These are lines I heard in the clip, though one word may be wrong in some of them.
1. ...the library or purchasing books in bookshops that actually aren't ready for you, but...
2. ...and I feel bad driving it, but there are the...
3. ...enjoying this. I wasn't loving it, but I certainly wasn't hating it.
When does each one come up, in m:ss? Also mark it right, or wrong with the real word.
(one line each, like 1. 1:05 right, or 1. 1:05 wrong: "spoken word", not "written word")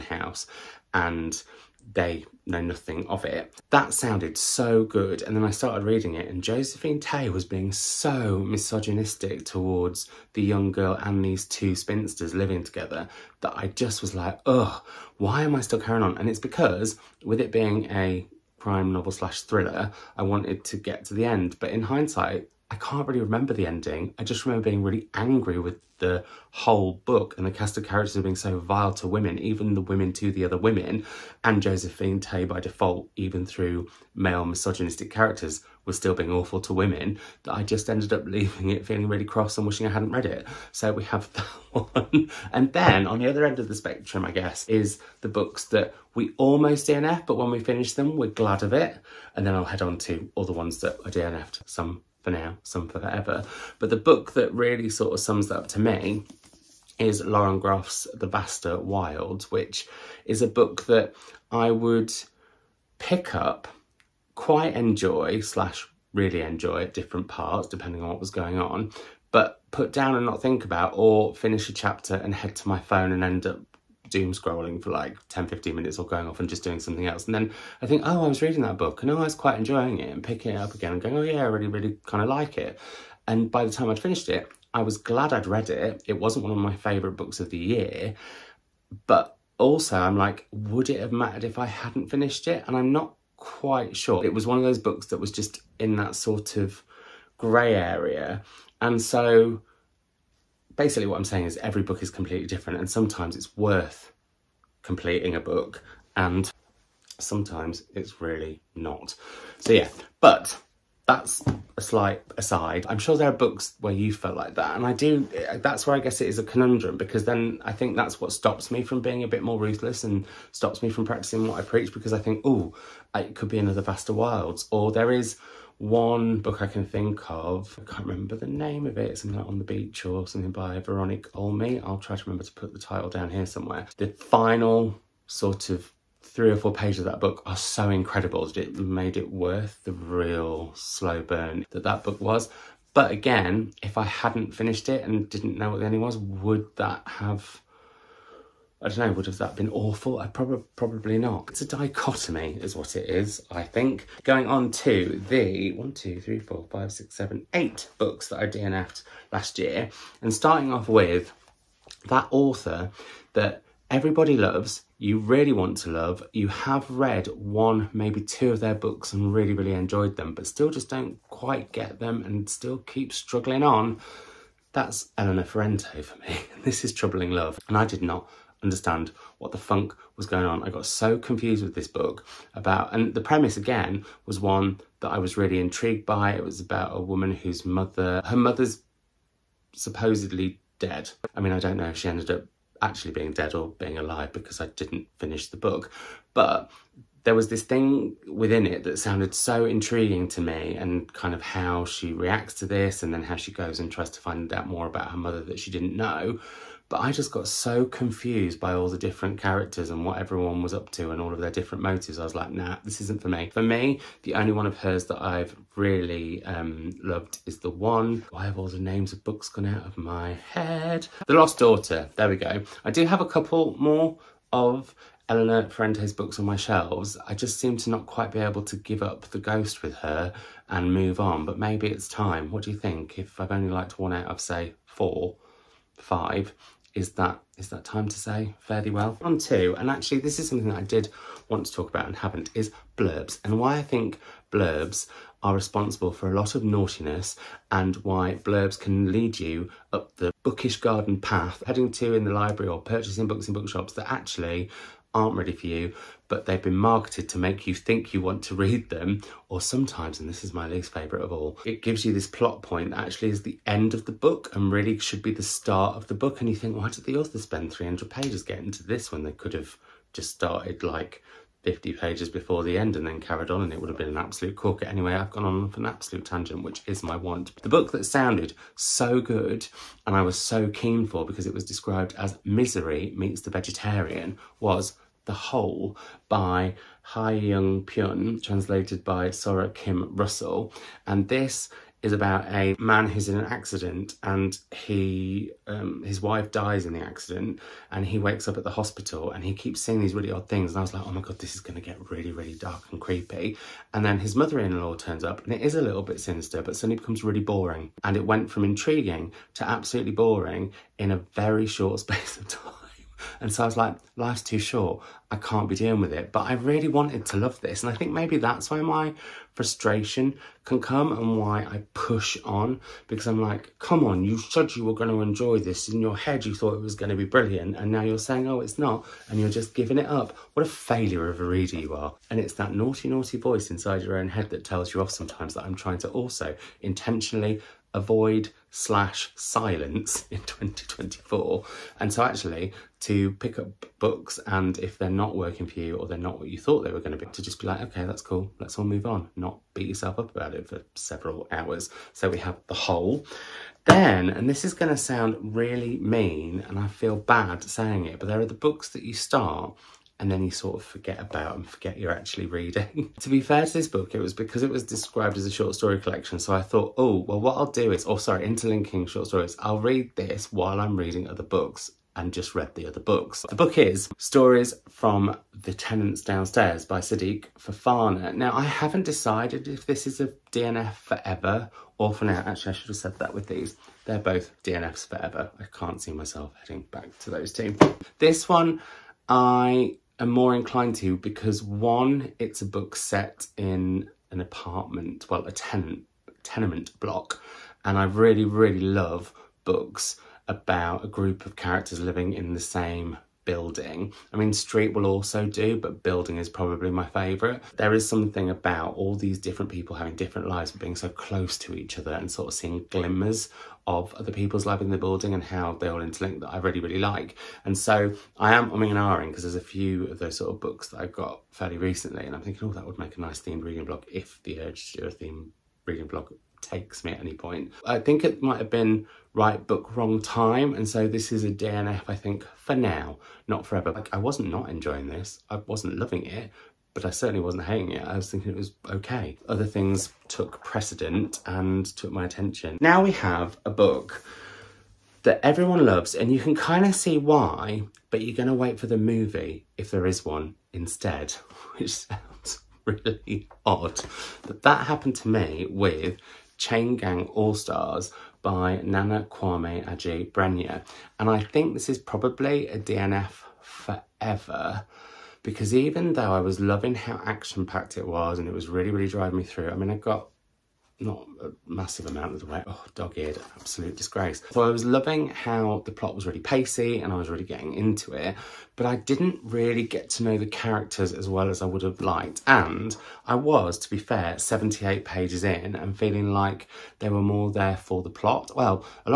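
1. 4:12 right
2. 5:56 wrong: "saying", not "driving"
3. 7:14 right.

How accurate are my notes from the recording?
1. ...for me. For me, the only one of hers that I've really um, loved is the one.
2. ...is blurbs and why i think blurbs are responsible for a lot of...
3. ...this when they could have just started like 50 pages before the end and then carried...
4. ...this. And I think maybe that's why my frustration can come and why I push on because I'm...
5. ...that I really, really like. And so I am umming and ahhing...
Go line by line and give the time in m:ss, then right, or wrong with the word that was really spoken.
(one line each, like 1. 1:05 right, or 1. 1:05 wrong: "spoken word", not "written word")
1. 3:33 right
2. 4:02 right
3. 4:28 right
4. 5:17 right
5. 6:56 right.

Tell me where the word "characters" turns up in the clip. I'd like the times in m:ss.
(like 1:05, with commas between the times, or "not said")
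0:27, 0:35, 3:29, 6:41, 8:00.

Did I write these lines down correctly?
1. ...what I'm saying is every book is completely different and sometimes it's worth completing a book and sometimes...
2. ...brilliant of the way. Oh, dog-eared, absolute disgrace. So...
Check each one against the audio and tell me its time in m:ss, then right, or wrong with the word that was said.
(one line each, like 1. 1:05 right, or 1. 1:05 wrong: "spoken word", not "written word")
1. 1:41 right
2. 7:52 wrong: "amount", not "brilliant".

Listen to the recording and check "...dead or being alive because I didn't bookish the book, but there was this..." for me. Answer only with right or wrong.
wrong.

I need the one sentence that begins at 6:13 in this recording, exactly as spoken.
The book is Stories from the Tenants Downstairs by Sidik Fofana.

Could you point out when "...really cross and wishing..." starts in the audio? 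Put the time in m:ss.
0:39.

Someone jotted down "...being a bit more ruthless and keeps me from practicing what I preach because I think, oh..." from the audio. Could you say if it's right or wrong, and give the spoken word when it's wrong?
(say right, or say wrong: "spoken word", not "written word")
wrong: "stops", not "keeps".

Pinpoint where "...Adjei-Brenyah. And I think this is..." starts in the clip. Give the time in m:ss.
7:39.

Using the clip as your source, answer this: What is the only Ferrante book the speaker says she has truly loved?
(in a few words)
The Lost Daughter.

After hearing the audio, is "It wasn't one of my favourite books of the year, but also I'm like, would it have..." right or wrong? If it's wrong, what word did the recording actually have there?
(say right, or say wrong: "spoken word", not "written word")
right.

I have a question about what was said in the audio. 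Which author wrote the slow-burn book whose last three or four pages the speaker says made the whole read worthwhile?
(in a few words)
Veronique Olmi.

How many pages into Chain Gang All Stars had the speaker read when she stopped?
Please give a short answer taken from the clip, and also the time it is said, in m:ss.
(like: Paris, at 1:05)
78, at 8:04.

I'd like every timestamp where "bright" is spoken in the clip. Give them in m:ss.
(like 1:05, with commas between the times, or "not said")
not said.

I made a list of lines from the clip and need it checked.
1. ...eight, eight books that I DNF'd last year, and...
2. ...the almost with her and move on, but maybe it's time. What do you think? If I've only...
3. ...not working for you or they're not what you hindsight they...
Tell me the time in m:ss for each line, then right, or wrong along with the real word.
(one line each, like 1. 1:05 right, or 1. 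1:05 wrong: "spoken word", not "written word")
1. 2:37 wrong: "seven", not "eight"
2. 3:49 wrong: "ghost", not "almost"
3. 5:45 wrong: "thought", not "hindsight".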